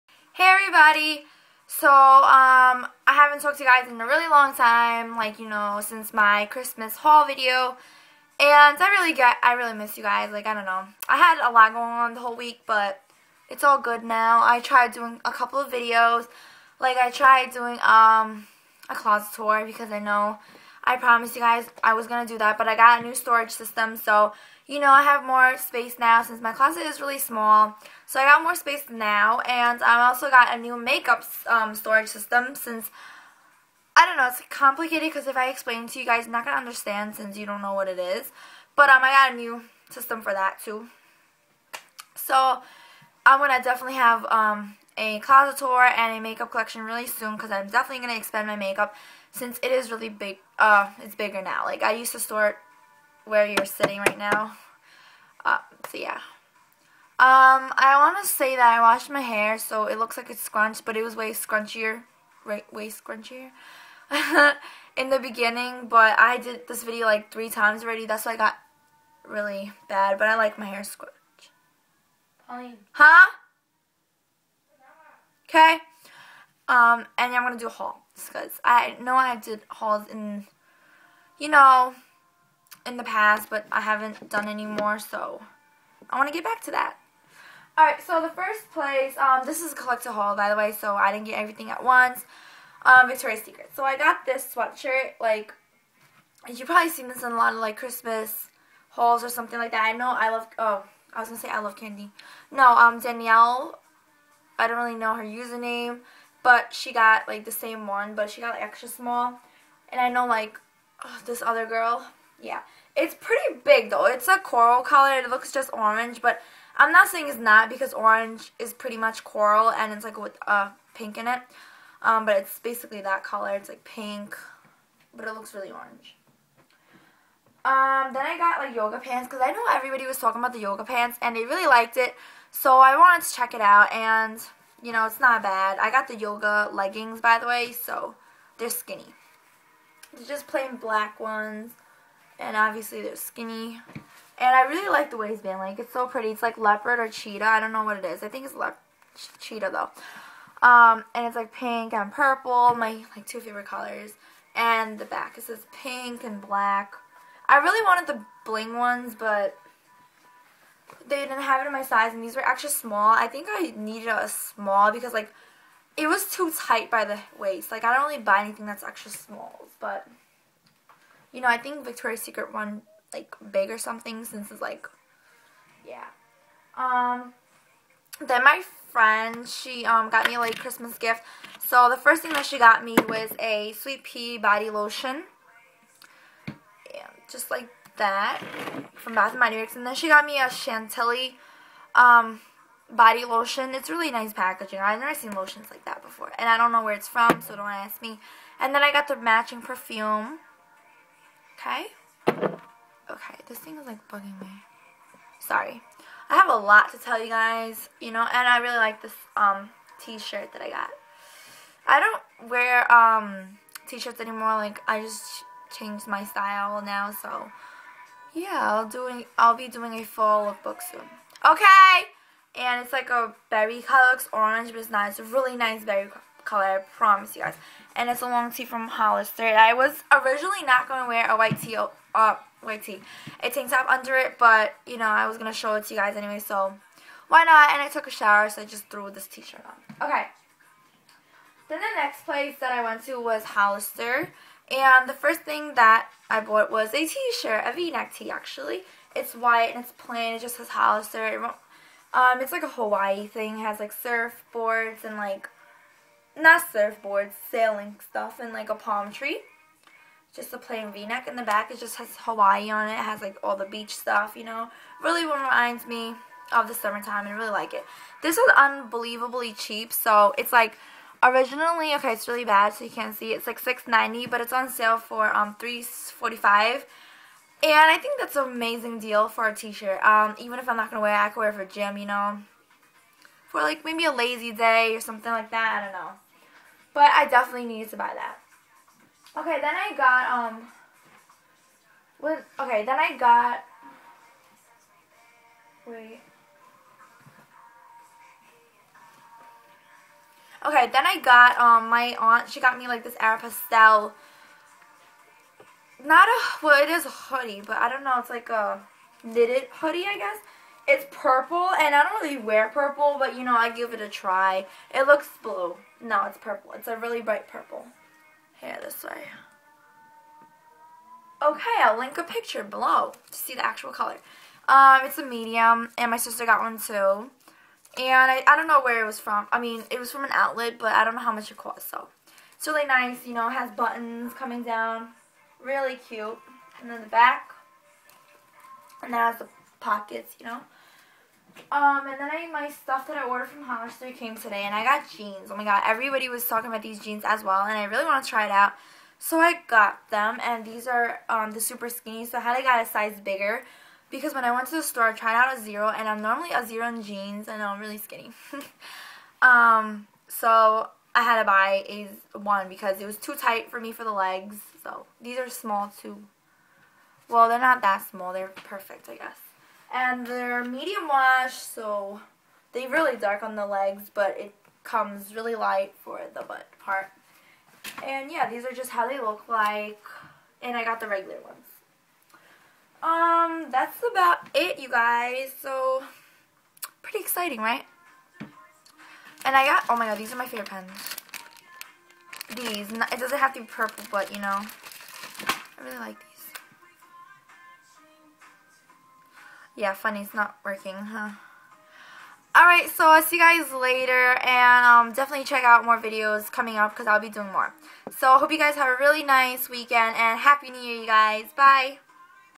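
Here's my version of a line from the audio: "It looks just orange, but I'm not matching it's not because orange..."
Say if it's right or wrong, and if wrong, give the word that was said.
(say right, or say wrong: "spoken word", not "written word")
wrong: "saying", not "matching".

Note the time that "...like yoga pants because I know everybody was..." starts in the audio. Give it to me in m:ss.
2:08.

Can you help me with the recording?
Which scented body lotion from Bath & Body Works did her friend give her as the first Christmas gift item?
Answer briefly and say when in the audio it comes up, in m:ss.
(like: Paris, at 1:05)
Sweet Pea, at 3:03.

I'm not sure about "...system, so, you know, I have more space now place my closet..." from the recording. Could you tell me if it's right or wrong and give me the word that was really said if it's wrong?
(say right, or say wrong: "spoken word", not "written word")
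wrong: "since", not "place".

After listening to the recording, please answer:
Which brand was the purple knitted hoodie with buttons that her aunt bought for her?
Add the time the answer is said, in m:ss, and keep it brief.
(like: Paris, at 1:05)
Aeropostale, at 5:03.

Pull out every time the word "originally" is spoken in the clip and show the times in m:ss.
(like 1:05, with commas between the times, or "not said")
3:50, 4:31.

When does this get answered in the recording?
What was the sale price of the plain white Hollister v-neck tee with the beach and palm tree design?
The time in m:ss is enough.
4:35.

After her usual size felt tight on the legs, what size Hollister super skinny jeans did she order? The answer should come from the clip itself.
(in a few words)
1.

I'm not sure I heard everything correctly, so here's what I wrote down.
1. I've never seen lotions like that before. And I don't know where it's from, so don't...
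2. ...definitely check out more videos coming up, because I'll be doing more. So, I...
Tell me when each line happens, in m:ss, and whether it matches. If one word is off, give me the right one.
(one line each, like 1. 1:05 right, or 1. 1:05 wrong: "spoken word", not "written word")
1. 3:14 right
2. 6:45 right.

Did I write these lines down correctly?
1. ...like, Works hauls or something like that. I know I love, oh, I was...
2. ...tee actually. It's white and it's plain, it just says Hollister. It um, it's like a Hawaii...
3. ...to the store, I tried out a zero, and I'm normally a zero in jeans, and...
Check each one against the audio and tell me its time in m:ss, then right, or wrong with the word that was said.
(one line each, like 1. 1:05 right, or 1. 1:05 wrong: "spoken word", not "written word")
1. 1:37 wrong: "Christmas", not "Works"
2. 4:08 right
3. 5:54 right.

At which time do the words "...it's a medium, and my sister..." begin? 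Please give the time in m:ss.
5:25.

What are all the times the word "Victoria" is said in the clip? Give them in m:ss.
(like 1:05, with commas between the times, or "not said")
1:33, 2:51.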